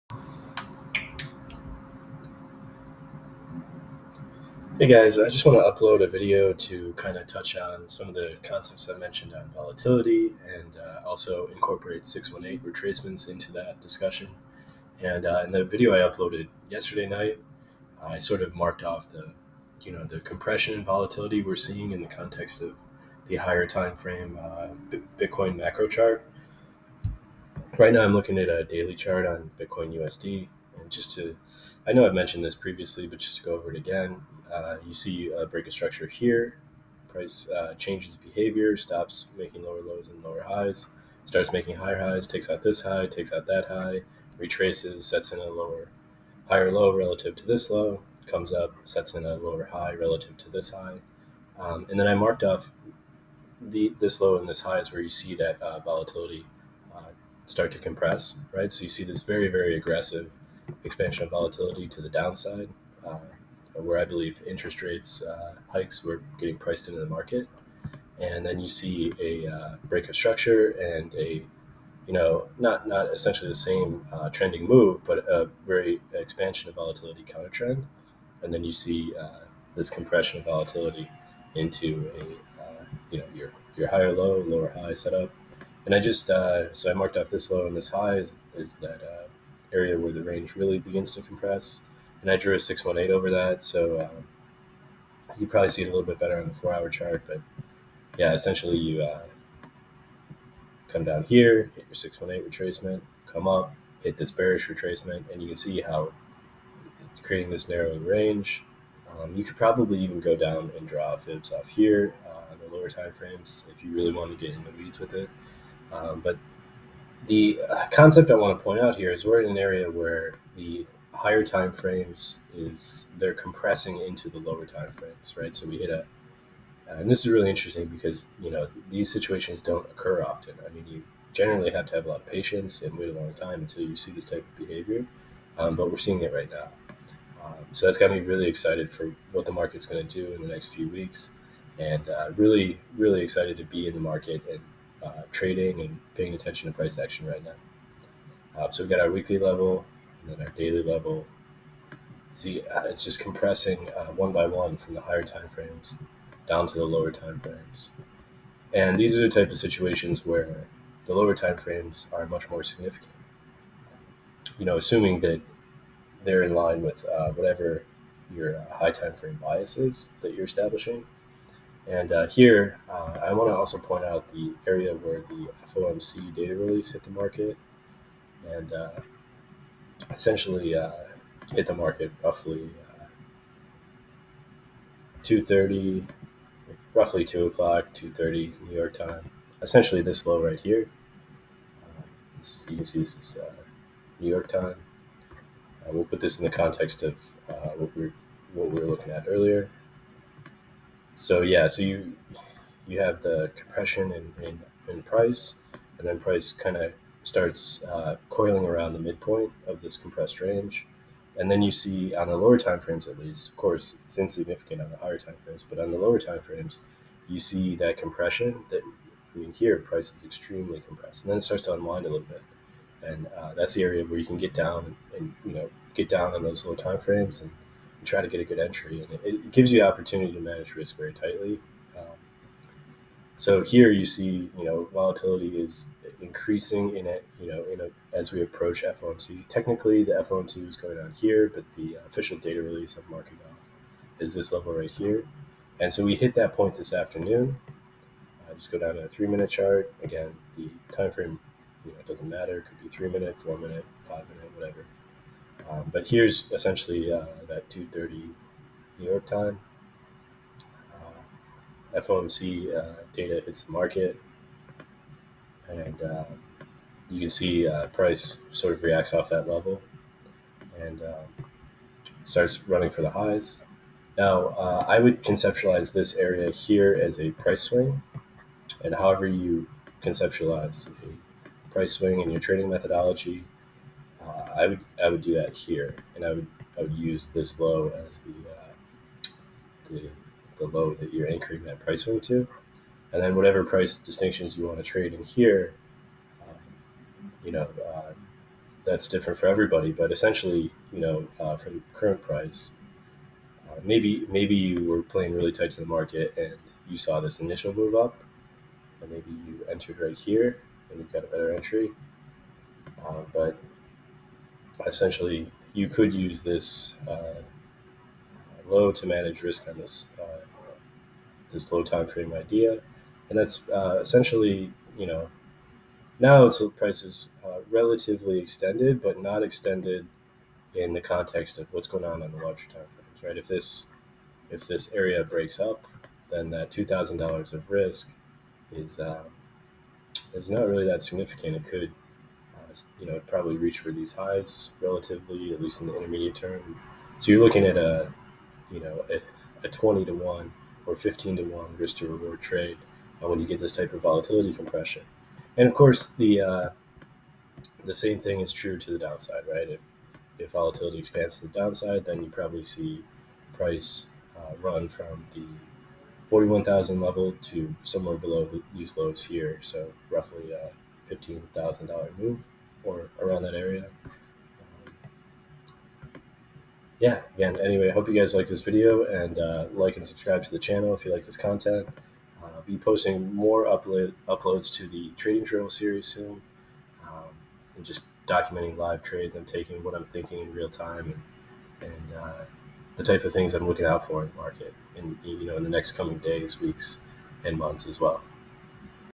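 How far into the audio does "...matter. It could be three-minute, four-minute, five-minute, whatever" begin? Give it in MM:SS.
04:12.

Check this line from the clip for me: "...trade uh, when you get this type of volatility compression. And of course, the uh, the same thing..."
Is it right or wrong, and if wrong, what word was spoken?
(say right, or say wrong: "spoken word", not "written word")
right.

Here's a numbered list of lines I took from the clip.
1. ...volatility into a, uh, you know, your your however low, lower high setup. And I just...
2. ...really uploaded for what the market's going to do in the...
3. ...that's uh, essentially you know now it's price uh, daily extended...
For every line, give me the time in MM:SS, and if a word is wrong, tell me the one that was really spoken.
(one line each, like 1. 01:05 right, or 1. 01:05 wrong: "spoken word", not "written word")
1. 01:20 wrong: "higher", not "however"
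2. 02:18 wrong: "excited", not "uploaded"
3. 05:23 wrong: "relatively", not "daily".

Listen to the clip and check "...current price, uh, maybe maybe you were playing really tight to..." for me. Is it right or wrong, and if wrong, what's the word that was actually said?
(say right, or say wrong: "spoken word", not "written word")
right.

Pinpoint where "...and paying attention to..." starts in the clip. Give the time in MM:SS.
02:25.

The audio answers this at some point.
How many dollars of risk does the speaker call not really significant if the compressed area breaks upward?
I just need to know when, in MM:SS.
05:36.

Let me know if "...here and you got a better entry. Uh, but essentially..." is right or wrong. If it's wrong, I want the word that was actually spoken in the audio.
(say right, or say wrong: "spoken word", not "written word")
right.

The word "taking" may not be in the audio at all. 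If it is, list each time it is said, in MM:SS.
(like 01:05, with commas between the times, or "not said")
06:29.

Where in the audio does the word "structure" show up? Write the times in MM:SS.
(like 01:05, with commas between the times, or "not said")
00:35, 01:10.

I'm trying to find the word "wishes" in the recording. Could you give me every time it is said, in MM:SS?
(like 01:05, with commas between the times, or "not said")
not said.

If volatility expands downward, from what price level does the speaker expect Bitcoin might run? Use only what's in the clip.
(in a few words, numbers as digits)
41,000.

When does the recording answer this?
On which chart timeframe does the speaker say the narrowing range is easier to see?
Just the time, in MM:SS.
01:36.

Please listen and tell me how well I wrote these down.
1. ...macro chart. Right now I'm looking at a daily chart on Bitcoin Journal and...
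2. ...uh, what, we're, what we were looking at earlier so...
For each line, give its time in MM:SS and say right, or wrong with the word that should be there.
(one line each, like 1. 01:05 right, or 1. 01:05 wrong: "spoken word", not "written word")
1. 00:25 wrong: "USD", not "Journal"
2. 03:17 right.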